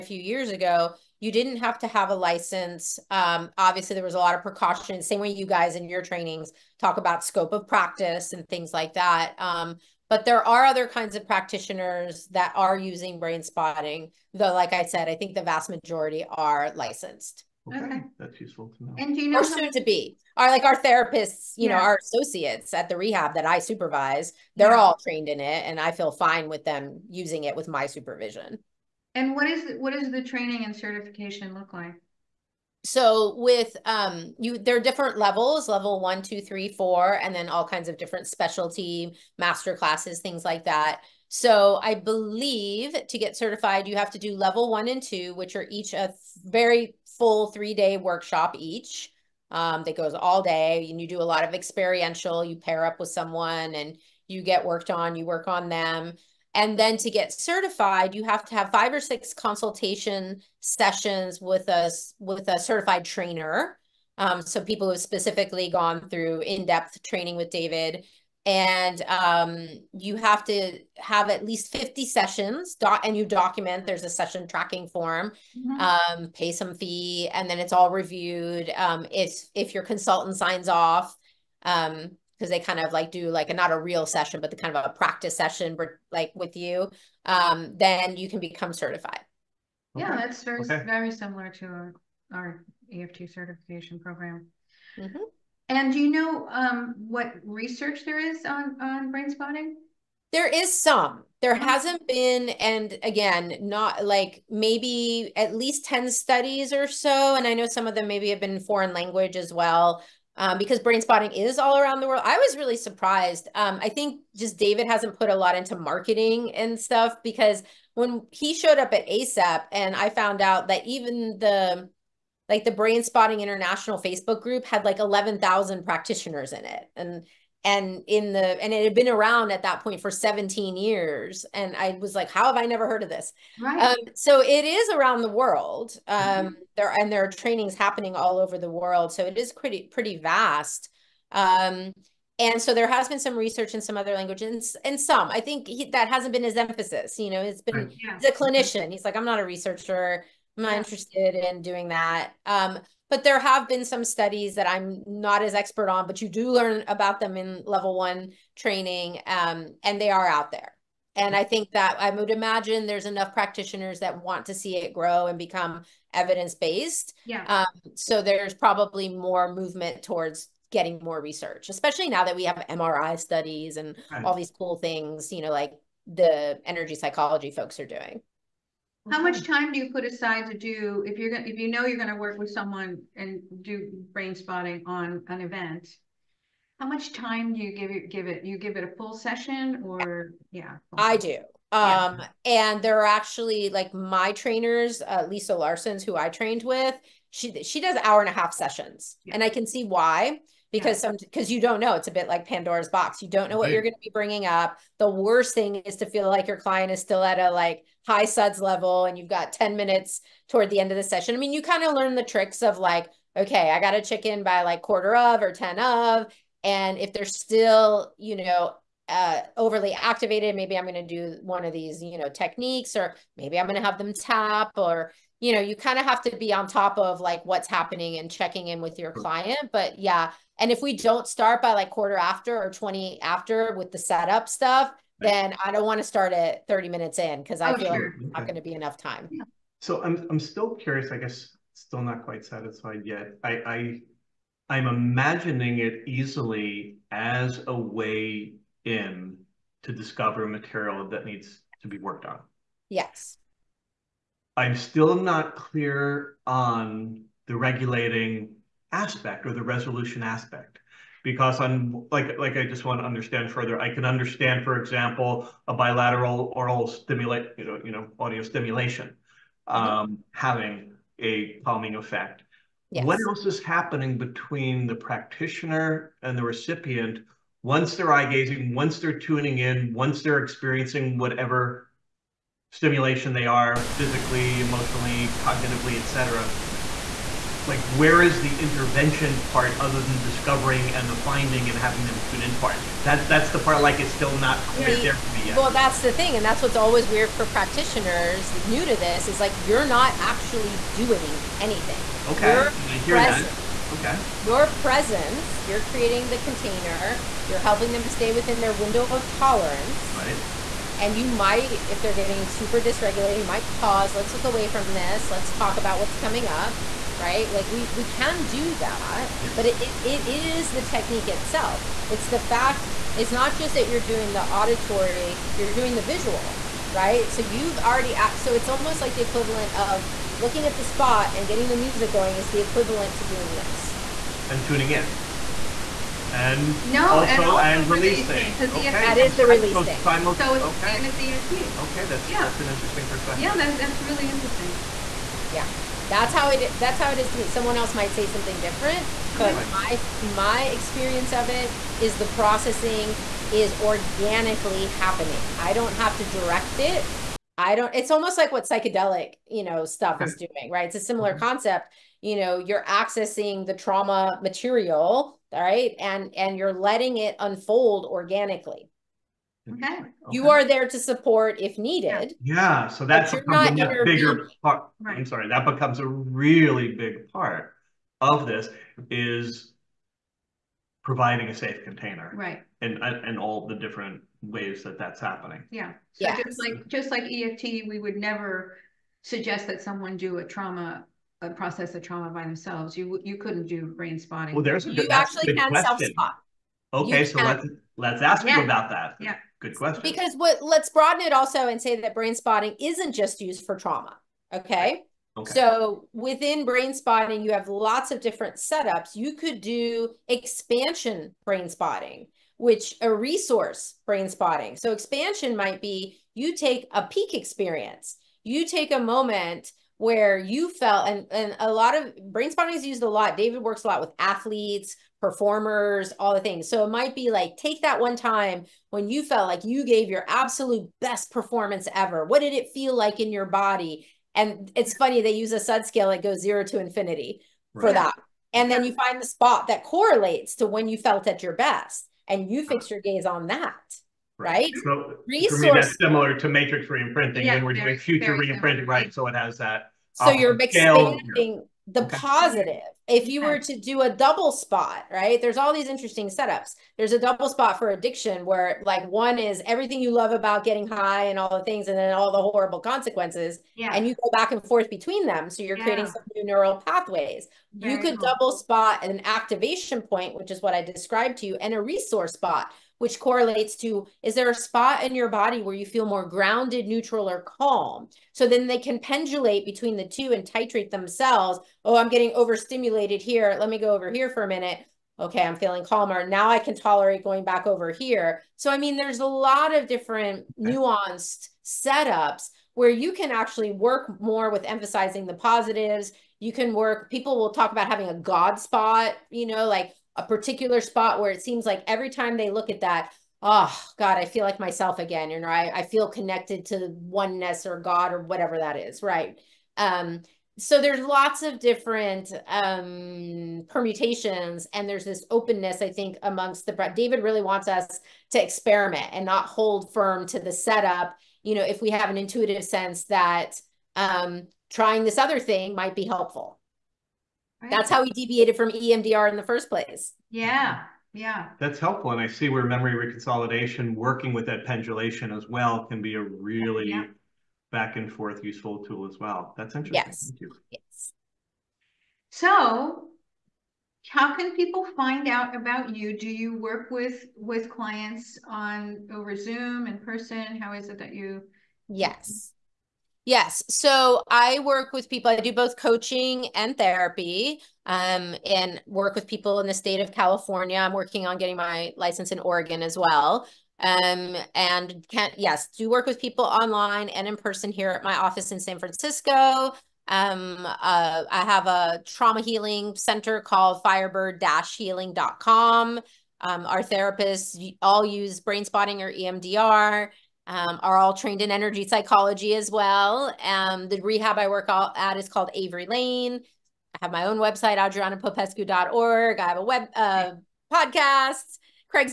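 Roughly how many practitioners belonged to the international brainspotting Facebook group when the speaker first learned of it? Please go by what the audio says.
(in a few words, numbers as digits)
11,000.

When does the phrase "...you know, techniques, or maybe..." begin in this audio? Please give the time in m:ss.
3:42.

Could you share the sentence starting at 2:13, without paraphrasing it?
Um, so it is around the world um, mm-hmm.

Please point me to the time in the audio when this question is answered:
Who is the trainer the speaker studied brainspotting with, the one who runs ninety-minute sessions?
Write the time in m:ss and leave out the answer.
3:15.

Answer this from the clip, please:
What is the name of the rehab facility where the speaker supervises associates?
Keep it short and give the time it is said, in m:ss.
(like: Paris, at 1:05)
Avery Lane, at 9:45.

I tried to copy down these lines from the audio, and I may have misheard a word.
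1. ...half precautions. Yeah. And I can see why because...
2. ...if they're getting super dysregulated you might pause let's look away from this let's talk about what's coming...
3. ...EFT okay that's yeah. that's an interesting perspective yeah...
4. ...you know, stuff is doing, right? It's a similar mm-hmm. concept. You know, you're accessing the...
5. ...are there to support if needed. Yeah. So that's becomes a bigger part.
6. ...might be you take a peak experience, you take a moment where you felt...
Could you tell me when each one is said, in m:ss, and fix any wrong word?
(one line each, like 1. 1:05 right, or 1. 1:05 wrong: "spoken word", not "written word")
1. 3:18 wrong: "sessions", not "precautions"
2. 5:11 right
3. 5:41 right
4. 5:59 right
5. 6:10 right
6. 6:55 right.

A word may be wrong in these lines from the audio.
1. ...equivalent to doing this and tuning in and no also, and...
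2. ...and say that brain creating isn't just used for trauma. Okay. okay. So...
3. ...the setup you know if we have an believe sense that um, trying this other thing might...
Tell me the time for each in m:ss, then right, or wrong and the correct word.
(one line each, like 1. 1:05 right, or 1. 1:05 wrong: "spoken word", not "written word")
1. 5:32 right
2. 6:41 wrong: "spotting", not "creating"
3. 8:40 wrong: "intuitive", not "believe".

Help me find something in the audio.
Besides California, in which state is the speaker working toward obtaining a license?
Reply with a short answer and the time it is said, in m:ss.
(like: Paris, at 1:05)
Oregon, at 9:22.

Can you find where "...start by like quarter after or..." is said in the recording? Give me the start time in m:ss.
3:51.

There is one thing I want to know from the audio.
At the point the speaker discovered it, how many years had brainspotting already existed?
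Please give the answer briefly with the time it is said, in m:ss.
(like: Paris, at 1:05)
17, at 2:10.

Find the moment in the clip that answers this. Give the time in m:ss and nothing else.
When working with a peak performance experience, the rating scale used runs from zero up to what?
7:16.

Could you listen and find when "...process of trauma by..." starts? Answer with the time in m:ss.
6:31.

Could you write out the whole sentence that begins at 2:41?
And I think that I would imagine there's enough practitioners that want to see it grow and become evidence based.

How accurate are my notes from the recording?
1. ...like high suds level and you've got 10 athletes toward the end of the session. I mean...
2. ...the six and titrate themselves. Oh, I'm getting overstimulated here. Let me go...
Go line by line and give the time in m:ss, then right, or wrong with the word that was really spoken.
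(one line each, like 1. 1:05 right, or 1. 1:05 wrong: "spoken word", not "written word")
1. 3:27 wrong: "minutes", not "athletes"
2. 7:59 wrong: "two", not "six".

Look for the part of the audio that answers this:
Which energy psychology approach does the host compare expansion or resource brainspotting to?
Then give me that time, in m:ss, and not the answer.
7:26.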